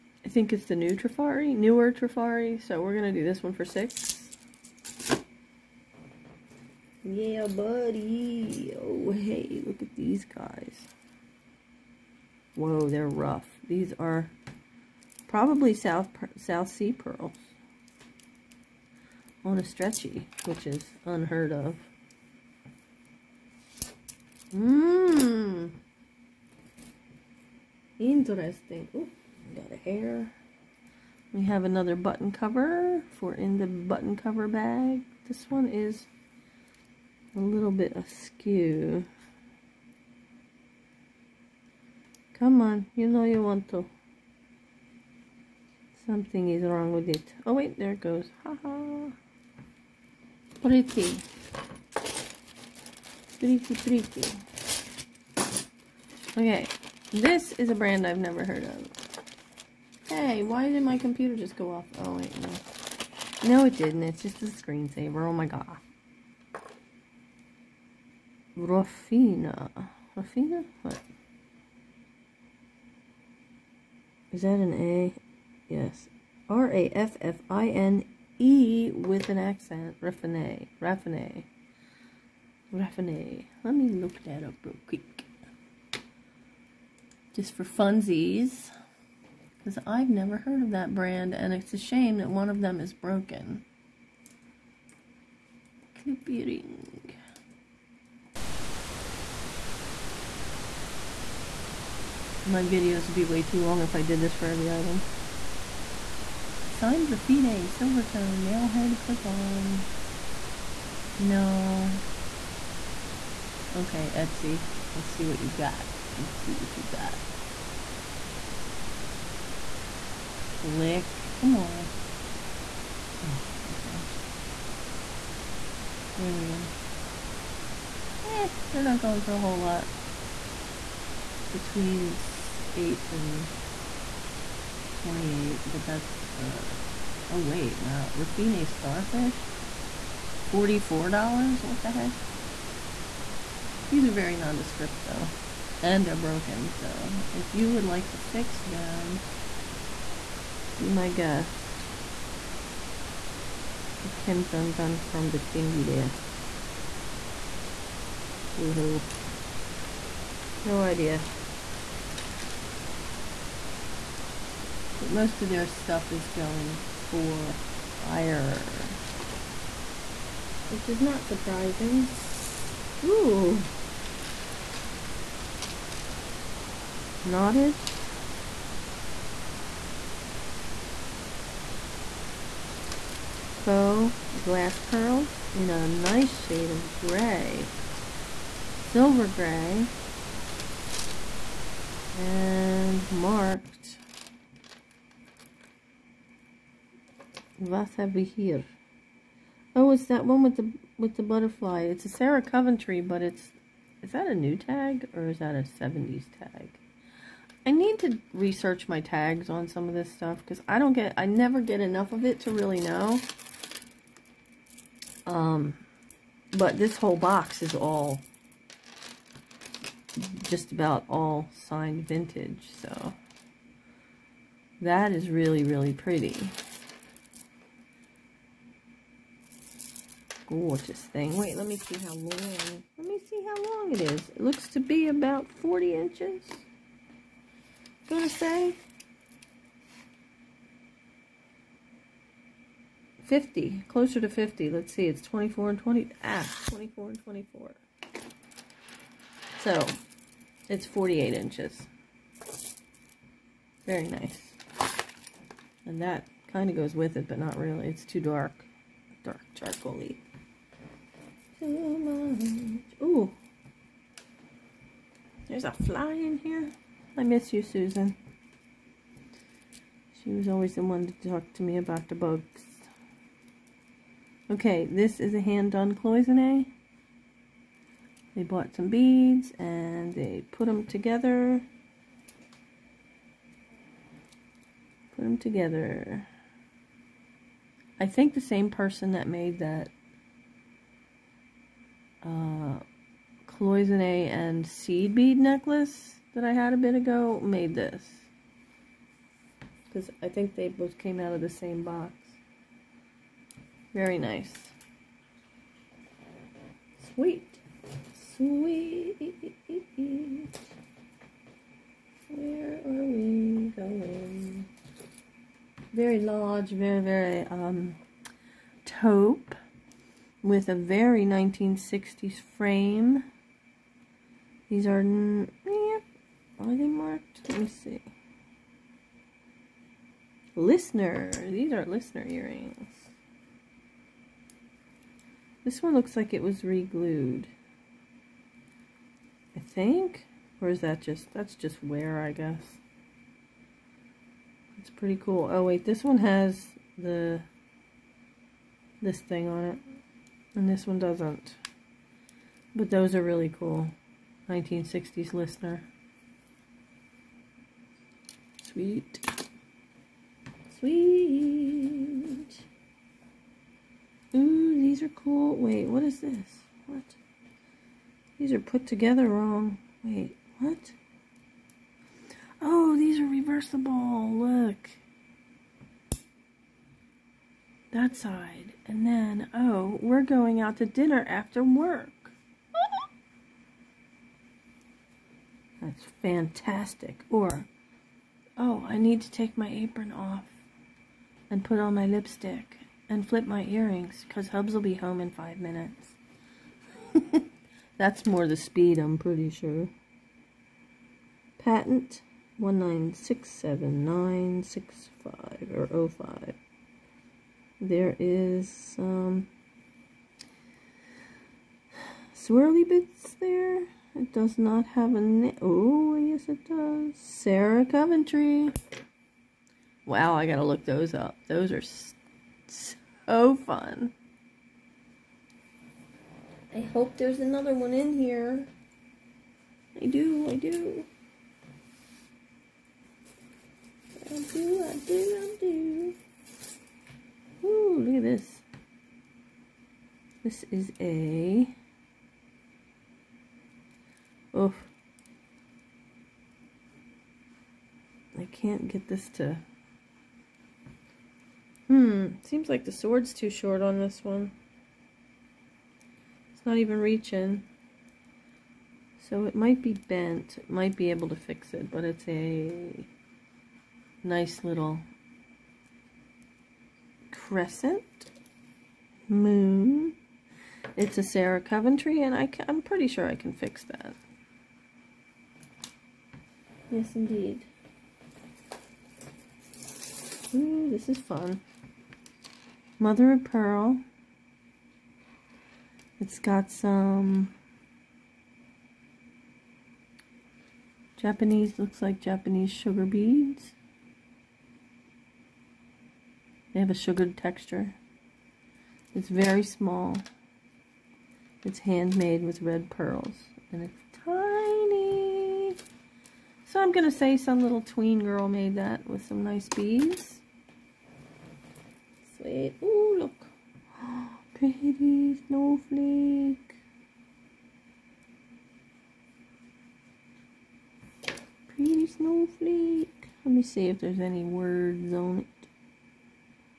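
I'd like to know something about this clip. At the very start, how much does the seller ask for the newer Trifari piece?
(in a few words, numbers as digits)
6.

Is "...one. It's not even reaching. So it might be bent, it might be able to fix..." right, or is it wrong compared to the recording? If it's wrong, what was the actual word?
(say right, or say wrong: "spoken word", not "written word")
right.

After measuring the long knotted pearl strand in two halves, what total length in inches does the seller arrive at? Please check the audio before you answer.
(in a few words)
48 inches.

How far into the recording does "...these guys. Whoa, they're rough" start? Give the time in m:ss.
0:09.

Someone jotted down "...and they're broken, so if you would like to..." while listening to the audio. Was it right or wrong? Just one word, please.
right.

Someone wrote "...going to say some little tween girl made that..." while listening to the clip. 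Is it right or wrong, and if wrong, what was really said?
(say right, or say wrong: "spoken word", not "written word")
right.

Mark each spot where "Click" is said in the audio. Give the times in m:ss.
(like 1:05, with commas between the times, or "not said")
2:00.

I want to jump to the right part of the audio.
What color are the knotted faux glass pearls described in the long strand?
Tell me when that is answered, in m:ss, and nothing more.
3:08.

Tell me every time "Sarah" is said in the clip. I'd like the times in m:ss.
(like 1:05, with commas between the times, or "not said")
3:22, 6:57, 7:51.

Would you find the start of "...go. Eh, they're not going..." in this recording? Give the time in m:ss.
2:06.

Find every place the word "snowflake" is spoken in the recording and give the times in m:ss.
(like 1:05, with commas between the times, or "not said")
8:35, 8:42.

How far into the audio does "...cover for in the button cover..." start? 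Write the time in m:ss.
0:32.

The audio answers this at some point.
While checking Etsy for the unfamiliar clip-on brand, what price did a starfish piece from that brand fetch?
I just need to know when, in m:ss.
2:20.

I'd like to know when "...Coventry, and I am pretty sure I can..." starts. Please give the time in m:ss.
7:51.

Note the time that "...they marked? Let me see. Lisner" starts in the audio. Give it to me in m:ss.
5:26.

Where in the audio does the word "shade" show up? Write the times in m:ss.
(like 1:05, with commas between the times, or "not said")
3:06.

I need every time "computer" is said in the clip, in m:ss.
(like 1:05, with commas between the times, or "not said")
1:00.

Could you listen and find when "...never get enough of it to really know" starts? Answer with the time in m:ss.
3:31.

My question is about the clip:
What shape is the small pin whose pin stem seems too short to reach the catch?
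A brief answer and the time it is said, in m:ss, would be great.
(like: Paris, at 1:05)
crescent moon, at 7:47.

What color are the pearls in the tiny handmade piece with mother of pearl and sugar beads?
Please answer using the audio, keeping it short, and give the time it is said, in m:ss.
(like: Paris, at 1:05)
red, at 8:22.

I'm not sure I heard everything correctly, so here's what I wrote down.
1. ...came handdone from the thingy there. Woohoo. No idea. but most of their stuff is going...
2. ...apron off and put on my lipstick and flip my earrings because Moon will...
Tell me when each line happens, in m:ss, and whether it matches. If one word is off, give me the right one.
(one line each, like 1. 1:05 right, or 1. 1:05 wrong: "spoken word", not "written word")
1. 2:34 wrong: "undone", not "handdone"
2. 6:29 wrong: "Hubs", not "Moon".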